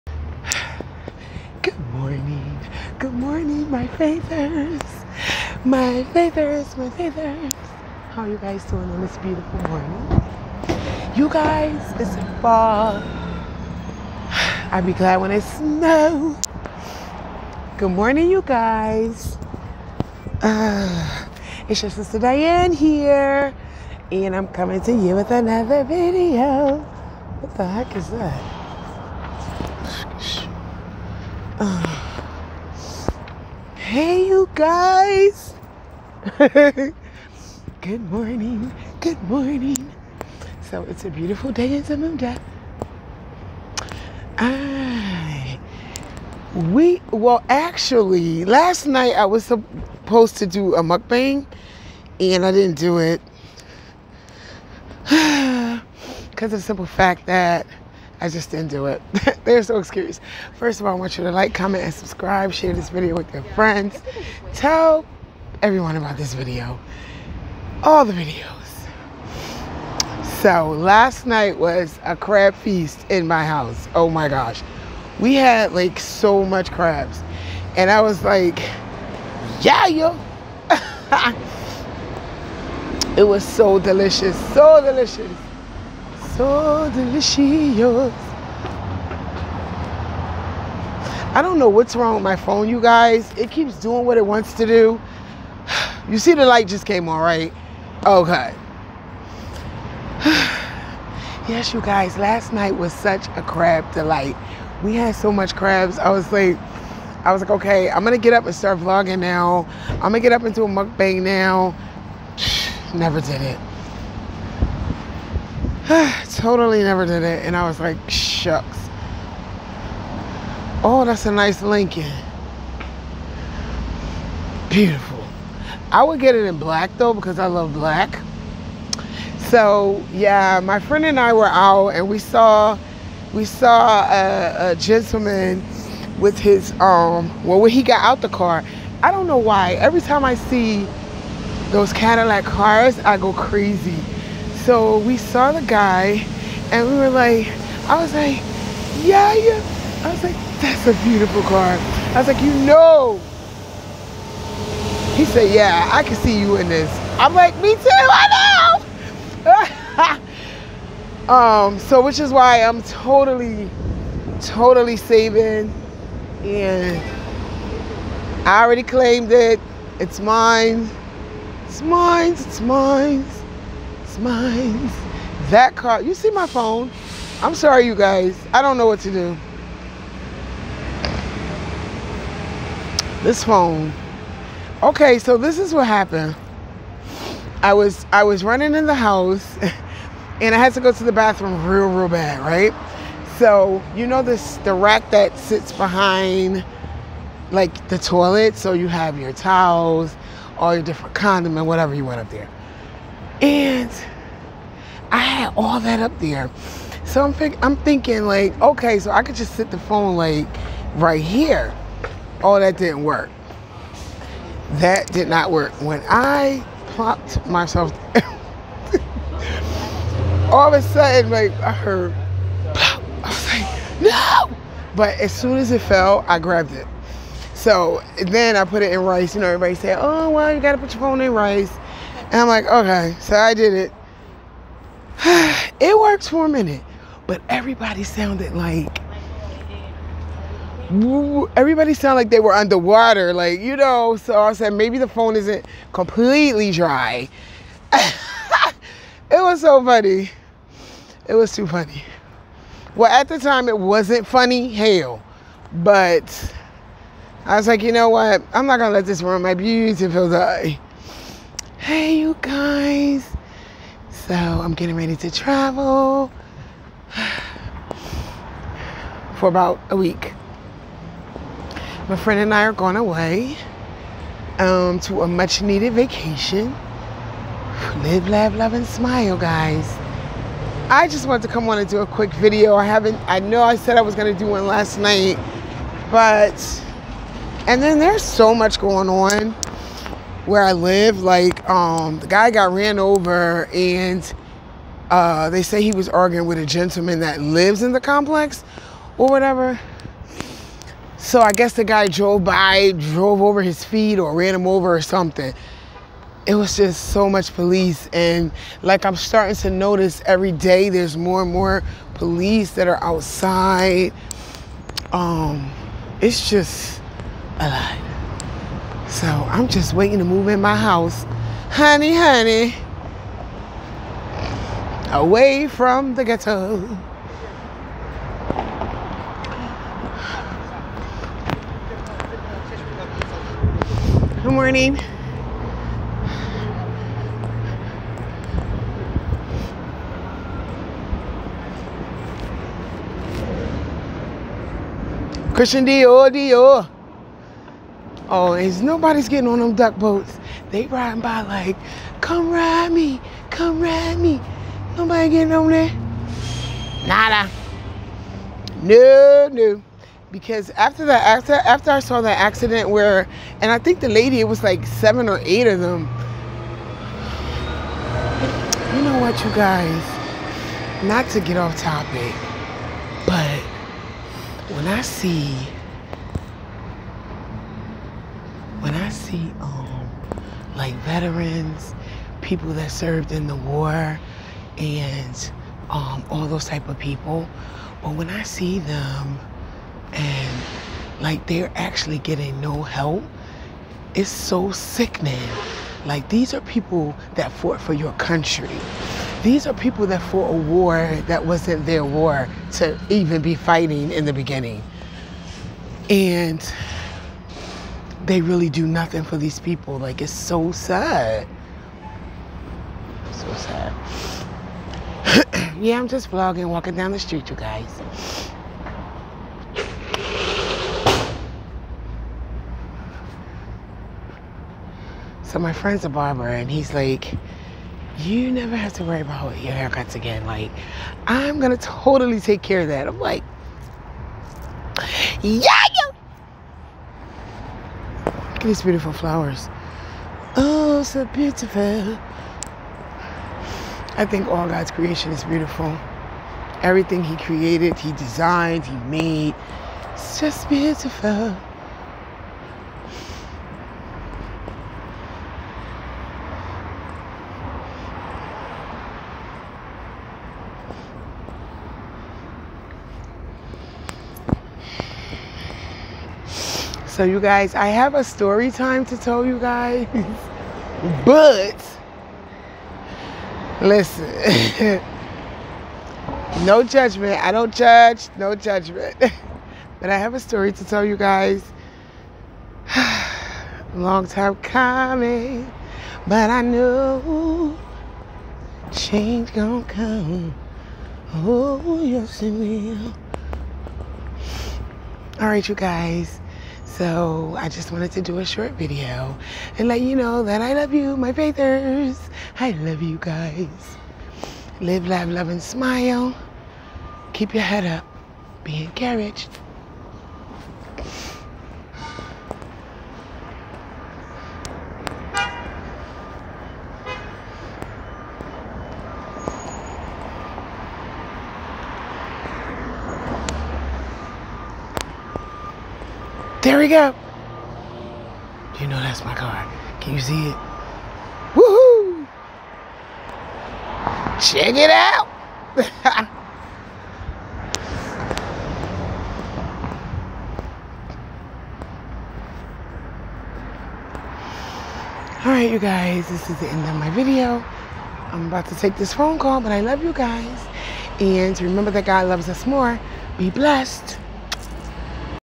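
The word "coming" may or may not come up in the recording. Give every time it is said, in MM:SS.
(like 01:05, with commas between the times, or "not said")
00:24, 08:04.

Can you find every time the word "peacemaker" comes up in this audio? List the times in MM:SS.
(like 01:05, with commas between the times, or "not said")
not said.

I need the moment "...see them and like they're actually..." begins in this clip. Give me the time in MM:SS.
06:28.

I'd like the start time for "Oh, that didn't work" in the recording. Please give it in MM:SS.
03:32.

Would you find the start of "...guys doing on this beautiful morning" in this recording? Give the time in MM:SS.
00:08.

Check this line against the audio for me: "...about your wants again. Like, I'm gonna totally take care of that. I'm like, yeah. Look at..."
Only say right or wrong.
wrong.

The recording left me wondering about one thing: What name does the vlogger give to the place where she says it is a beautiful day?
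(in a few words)
Zamunda.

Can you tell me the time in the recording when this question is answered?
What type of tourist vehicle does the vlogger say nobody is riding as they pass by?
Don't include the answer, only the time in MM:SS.
05:49.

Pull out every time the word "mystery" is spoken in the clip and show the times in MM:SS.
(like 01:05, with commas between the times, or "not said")
not said.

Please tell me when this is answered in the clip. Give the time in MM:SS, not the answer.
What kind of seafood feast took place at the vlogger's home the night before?
01:12.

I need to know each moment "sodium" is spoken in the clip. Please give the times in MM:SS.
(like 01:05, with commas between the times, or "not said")
not said.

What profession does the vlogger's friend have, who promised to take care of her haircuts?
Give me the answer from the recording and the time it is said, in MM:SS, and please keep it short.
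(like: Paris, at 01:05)
barber, at 07:06.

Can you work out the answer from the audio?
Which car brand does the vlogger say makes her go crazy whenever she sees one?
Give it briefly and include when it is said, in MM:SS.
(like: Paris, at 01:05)
Cadillac, at 02:21.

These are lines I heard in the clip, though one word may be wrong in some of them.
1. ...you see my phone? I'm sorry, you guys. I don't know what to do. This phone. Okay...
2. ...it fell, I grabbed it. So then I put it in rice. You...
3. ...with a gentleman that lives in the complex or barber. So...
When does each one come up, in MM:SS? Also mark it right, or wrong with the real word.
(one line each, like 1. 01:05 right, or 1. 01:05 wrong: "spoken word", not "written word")
1. 02:56 right
2. 03:45 right
3. 04:56 wrong: "whatever", not "barber".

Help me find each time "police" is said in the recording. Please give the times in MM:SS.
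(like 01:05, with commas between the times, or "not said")
05:07, 05:12.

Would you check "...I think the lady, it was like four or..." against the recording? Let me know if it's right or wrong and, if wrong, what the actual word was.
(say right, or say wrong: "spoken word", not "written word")
wrong: "seven", not "four".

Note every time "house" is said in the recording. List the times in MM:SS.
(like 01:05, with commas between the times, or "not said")
01:13, 03:08, 05:20.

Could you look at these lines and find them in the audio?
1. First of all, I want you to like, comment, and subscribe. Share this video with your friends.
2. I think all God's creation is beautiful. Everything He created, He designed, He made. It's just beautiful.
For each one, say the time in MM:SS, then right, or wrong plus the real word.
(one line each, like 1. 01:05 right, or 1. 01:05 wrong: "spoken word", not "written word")
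1. 01:00 right
2. 07:24 right.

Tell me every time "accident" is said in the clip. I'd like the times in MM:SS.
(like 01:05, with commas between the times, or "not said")
06:02.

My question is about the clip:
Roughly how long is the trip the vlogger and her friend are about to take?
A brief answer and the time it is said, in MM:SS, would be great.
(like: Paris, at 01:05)
about a week, at 04:29.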